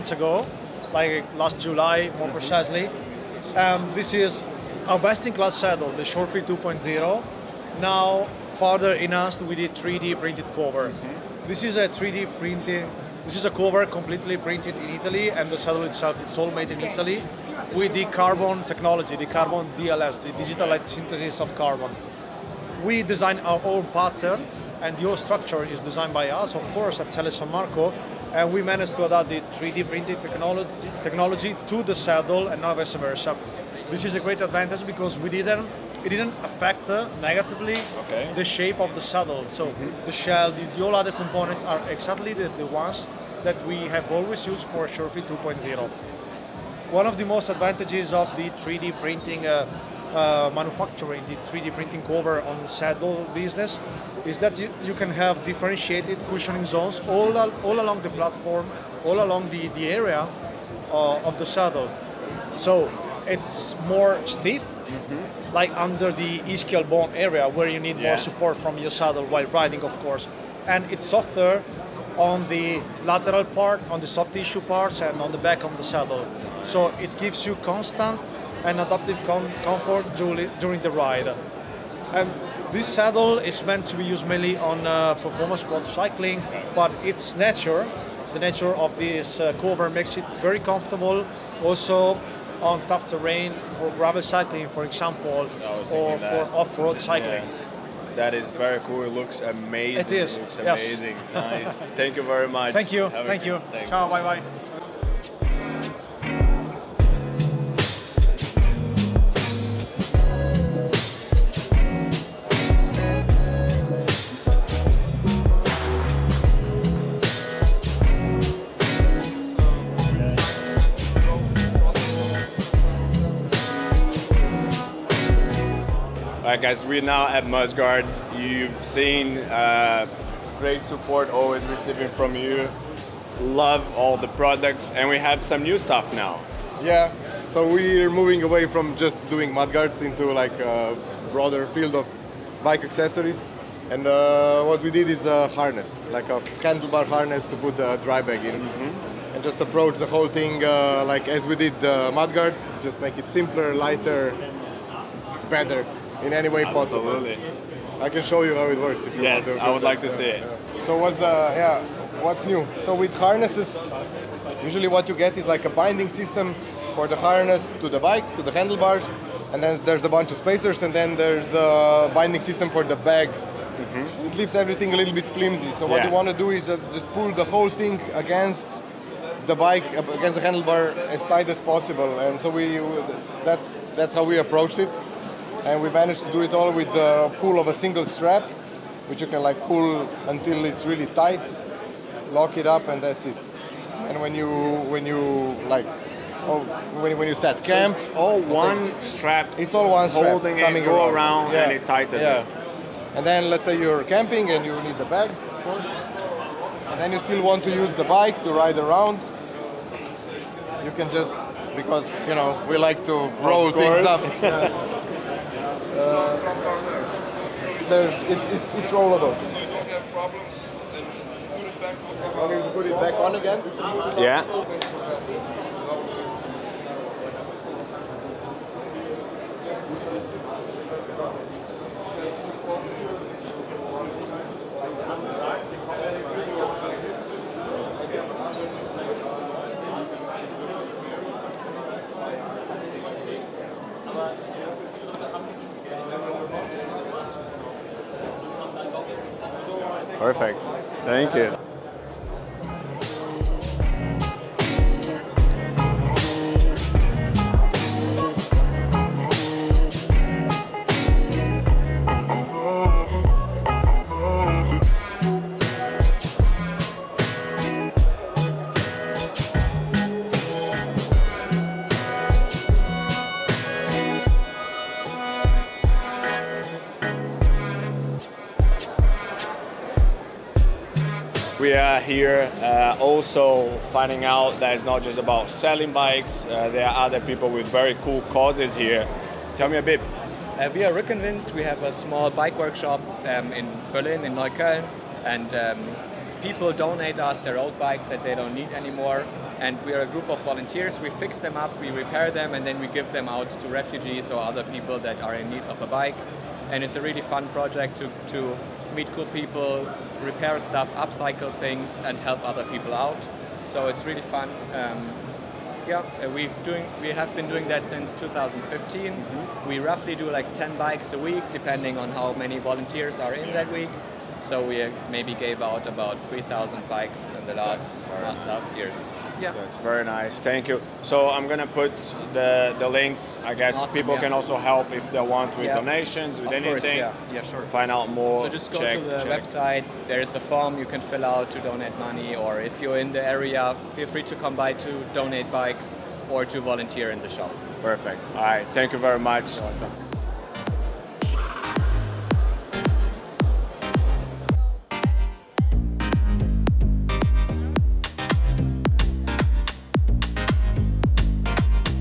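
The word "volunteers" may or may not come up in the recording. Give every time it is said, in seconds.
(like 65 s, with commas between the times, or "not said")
300 s, 322 s, 346 s.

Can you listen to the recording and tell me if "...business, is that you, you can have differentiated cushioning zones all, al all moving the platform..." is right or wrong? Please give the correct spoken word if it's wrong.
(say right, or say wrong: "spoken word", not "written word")
wrong: "along", not "moving".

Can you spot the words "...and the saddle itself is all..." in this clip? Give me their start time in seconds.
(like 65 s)
15 s.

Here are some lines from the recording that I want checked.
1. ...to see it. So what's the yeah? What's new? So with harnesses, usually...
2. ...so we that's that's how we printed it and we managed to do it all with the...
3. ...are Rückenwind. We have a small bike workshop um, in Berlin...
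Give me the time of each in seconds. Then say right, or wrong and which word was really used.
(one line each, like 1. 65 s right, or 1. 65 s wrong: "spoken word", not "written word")
1. 160 s right
2. 182 s wrong: "approached", not "printed"
3. 290 s right.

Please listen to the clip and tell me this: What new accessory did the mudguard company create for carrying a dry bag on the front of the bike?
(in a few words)
handlebar harness.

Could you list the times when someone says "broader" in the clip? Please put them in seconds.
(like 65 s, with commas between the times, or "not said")
141 s.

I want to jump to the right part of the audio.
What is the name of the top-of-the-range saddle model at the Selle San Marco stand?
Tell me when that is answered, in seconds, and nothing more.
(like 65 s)
5 s.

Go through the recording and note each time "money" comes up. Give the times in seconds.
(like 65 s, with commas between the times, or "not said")
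341 s.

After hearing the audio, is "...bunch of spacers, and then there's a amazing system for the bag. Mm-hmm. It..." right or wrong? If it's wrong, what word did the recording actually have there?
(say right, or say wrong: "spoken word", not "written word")
wrong: "binding", not "amazing".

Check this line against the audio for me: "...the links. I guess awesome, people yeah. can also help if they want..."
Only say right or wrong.
right.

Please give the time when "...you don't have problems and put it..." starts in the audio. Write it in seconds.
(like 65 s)
219 s.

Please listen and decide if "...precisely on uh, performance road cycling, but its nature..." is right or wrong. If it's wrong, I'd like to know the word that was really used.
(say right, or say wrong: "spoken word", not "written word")
wrong: "mainly", not "precisely".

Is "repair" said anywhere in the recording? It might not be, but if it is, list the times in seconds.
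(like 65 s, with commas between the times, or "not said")
301 s, 310 s.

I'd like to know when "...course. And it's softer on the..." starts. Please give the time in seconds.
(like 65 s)
69 s.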